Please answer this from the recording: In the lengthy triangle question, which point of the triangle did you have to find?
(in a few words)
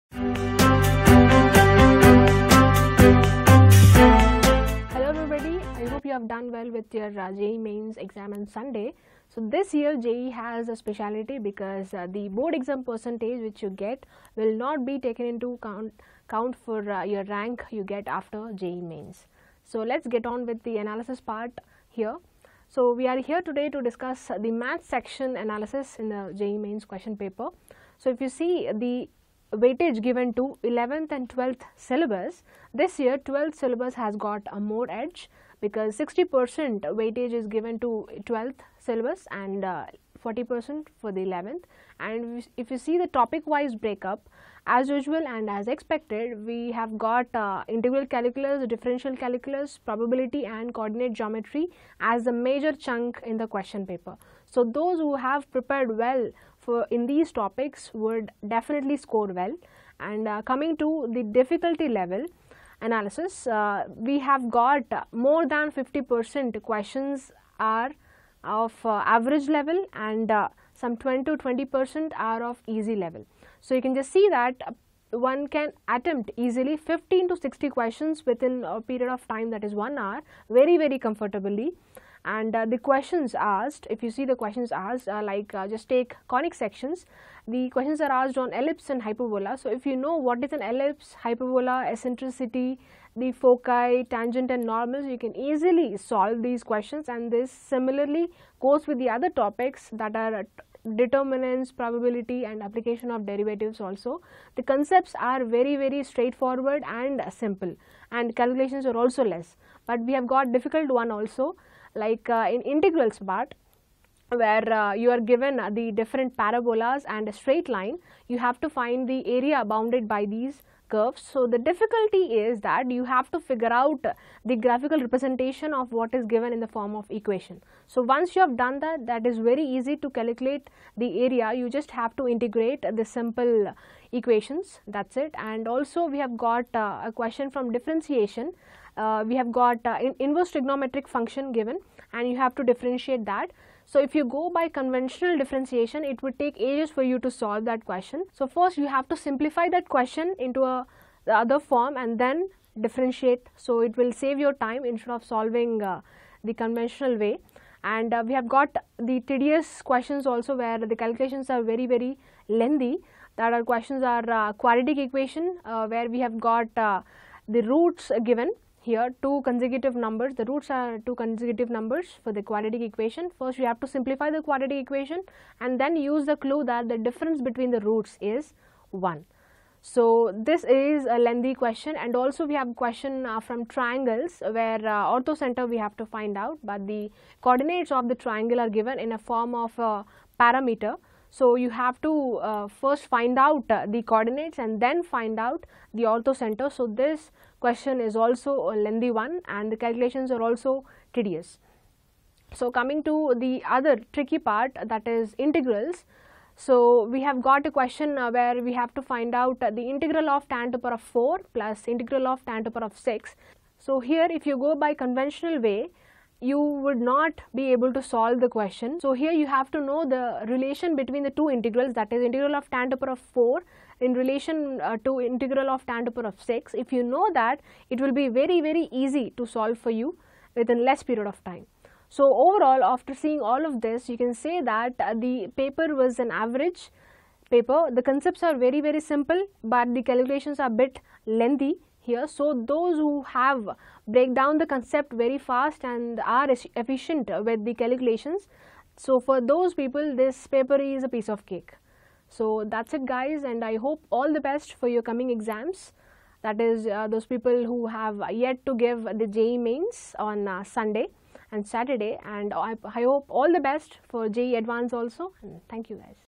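orthocenter.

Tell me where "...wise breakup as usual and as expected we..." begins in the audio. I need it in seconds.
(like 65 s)
43 s.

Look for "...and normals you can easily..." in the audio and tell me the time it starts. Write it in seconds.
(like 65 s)
94 s.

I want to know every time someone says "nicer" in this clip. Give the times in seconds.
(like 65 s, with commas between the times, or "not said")
not said.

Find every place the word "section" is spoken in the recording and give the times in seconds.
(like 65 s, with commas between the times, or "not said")
24 s, 86 s.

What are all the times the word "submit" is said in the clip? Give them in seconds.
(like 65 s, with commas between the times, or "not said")
not said.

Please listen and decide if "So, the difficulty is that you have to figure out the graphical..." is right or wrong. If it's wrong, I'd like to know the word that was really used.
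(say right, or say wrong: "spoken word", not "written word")
right.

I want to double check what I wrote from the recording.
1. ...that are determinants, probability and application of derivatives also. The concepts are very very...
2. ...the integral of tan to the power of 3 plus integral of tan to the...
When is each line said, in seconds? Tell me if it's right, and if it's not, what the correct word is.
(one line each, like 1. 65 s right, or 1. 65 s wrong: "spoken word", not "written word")
1. 99 s right
2. 209 s wrong: "4", not "3".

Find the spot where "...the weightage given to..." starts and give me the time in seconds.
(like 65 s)
28 s.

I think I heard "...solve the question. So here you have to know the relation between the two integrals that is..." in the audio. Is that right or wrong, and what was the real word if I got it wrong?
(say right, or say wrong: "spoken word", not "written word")
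right.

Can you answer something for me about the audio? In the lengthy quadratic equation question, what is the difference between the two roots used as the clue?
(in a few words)
1.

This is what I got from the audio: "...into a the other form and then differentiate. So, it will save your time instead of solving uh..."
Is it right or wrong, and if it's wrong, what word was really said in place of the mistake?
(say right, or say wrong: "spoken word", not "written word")
right.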